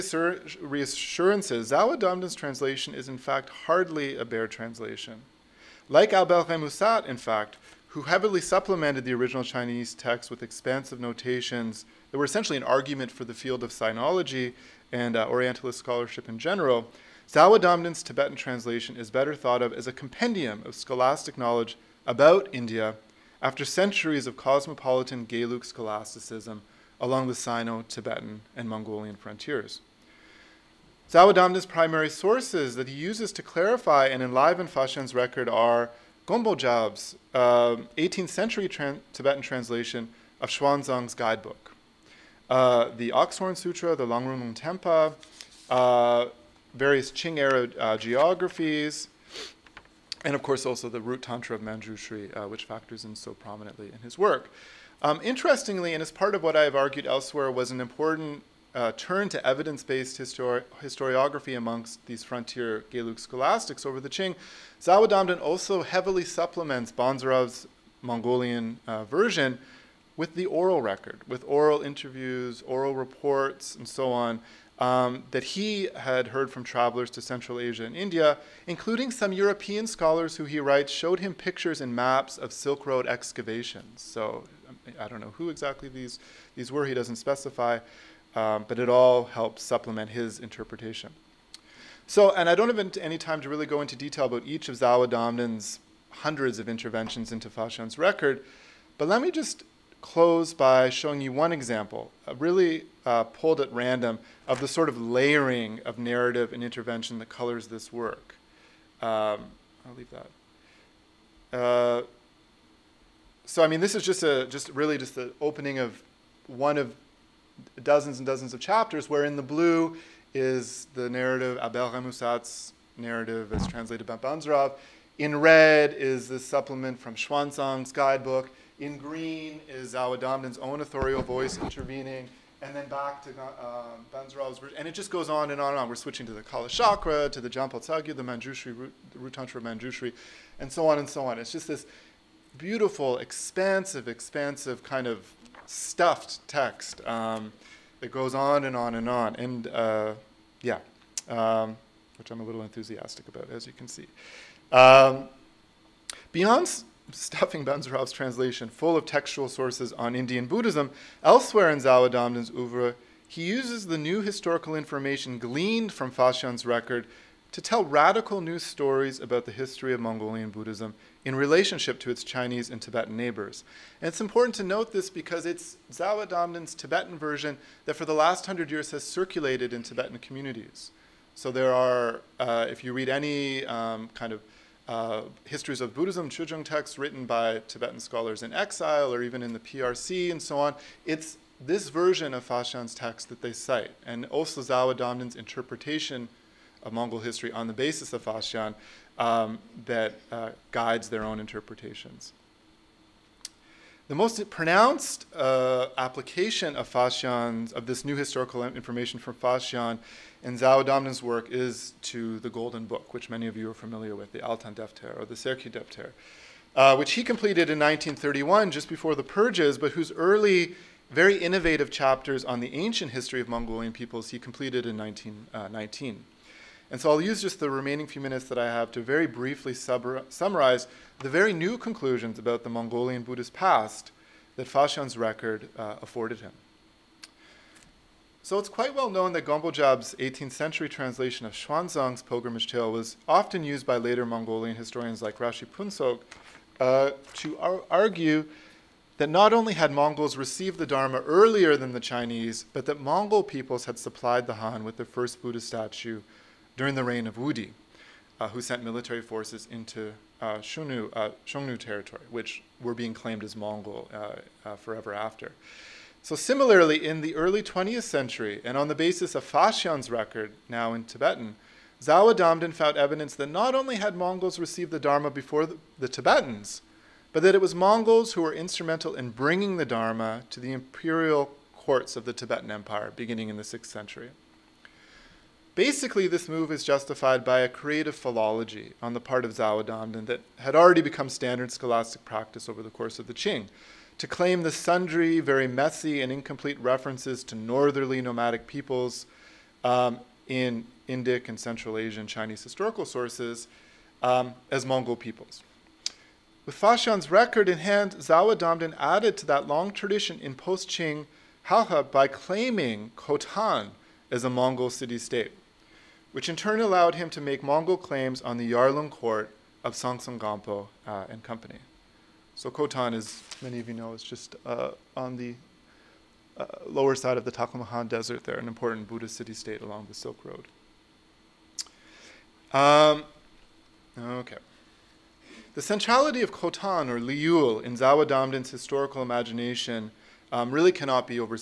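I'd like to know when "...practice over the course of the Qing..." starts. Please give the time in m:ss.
4:52.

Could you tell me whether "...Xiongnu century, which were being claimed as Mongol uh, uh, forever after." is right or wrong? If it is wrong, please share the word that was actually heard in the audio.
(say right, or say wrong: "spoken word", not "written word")
wrong: "territory", not "century".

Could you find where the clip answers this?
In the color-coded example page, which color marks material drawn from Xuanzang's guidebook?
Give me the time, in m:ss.
2:05.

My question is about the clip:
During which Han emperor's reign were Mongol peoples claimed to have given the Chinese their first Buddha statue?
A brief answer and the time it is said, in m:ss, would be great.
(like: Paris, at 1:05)
Wudi, at 4:17.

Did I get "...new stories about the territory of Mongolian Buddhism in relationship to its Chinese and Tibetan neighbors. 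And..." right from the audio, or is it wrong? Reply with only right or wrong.
wrong.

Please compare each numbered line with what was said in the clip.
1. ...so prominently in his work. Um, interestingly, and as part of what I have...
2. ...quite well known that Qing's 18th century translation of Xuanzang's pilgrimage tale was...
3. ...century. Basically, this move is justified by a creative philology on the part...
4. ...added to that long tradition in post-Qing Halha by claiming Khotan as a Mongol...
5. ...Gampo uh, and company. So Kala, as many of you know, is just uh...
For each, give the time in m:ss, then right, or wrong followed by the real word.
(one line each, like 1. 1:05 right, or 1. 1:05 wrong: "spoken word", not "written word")
1. 0:53 right
2. 3:58 wrong: "Gombojab", not "Qing"
3. 4:43 right
4. 5:08 right
5. 5:20 wrong: "Khotan", not "Kala".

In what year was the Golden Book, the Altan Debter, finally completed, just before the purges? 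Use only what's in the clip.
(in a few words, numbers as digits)
1931.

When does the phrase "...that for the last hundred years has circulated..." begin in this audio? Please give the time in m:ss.
2:57.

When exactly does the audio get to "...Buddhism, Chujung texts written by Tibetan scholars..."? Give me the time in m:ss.
3:05.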